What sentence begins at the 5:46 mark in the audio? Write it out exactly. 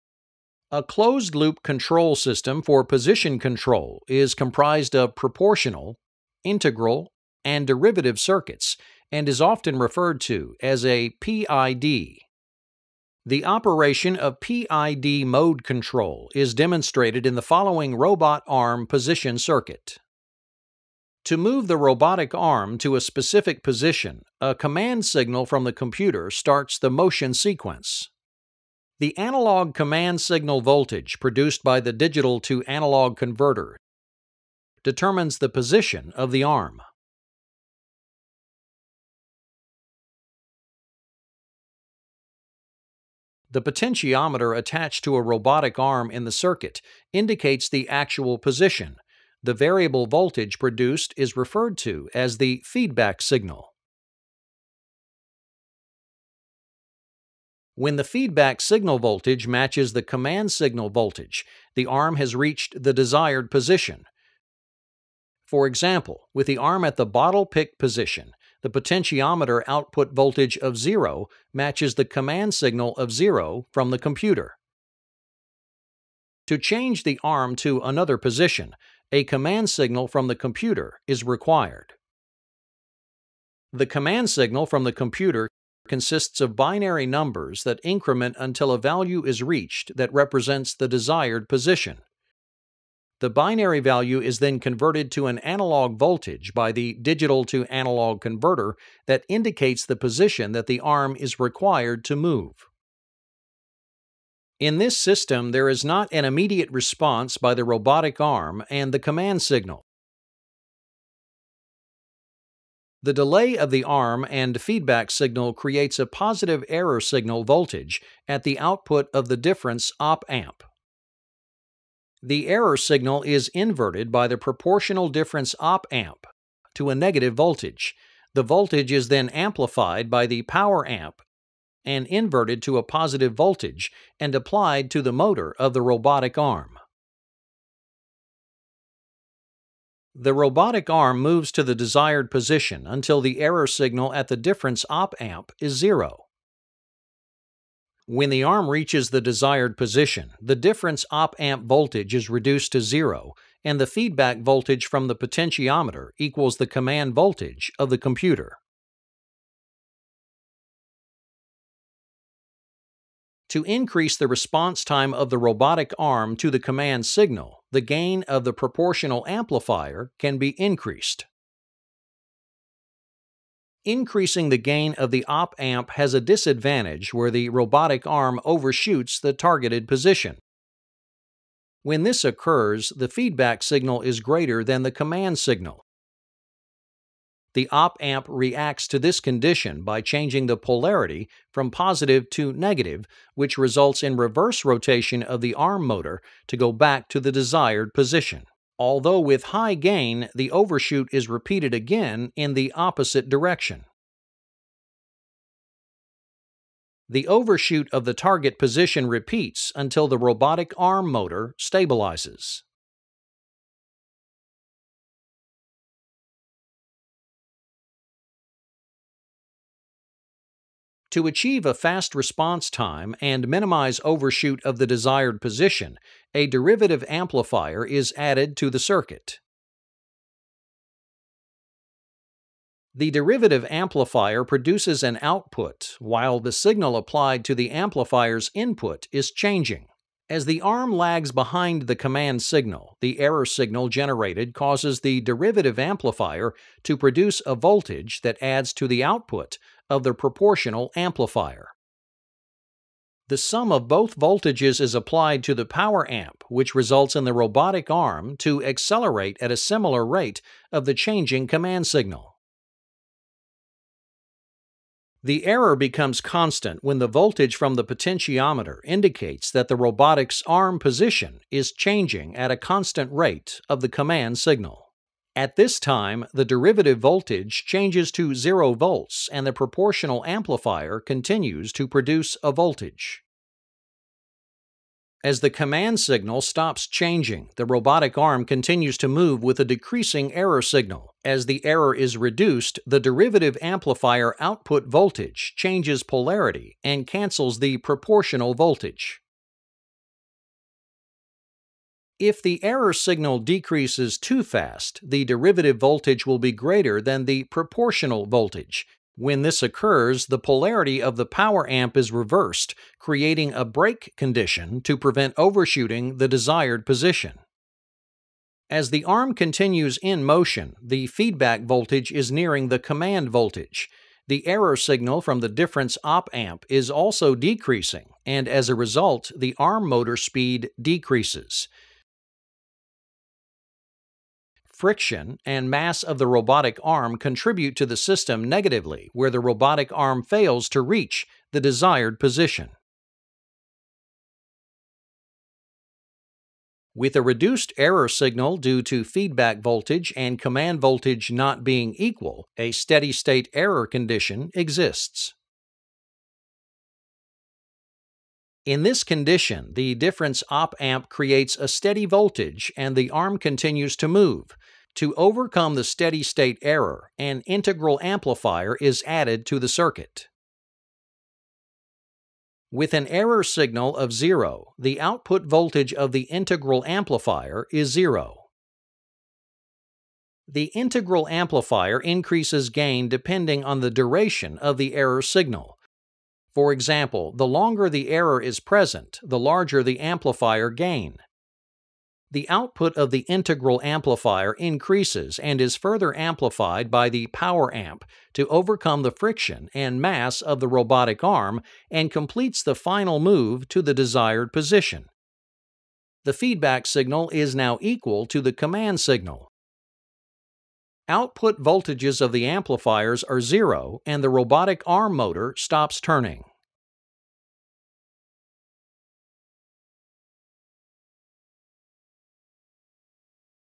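With a reduced error signal due to feedback voltage and command voltage not being equal, a steady state error condition exists.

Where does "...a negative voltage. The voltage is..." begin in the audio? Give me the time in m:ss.
2:06.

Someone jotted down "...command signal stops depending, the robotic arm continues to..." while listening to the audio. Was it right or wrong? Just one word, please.
wrong.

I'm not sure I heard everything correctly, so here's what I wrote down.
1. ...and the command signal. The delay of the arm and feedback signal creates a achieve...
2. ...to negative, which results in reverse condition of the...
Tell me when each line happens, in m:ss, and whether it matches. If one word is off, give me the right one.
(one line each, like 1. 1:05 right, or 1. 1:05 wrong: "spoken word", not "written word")
1. 1:48 wrong: "positive", not "achieve"
2. 3:12 wrong: "rotation", not "condition".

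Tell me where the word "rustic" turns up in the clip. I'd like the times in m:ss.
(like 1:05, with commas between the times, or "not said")
not said.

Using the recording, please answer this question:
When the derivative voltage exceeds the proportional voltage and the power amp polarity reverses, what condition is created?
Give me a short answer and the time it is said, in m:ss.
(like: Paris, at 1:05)
Brake condition, at 5:13.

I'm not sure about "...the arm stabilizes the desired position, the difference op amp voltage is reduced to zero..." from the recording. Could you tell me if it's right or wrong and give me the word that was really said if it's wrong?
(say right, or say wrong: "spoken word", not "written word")
wrong: "reaches", not "stabilizes".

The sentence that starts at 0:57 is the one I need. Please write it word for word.
When the feedback signal voltage matches the command signal voltage, the arm has reached the desired position.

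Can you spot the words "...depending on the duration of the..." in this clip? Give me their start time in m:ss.
6:23.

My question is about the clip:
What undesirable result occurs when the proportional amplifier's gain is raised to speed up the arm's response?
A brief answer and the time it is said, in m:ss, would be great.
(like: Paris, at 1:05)
Overshoots the targeted position, at 2:58.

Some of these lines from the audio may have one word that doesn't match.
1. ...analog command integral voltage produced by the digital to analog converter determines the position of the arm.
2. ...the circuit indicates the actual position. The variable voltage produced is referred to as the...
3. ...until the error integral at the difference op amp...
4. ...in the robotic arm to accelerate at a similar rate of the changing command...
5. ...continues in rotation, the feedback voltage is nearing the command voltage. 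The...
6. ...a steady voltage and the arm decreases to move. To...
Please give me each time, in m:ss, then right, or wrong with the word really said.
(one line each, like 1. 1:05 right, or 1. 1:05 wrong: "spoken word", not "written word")
1. 0:29 wrong: "signal", not "integral"
2. 0:46 right
3. 2:22 wrong: "signal", not "integral"
4. 4:17 right
5. 5:19 wrong: "motion", not "rotation"
6. 6:01 wrong: "continues", not "decreases".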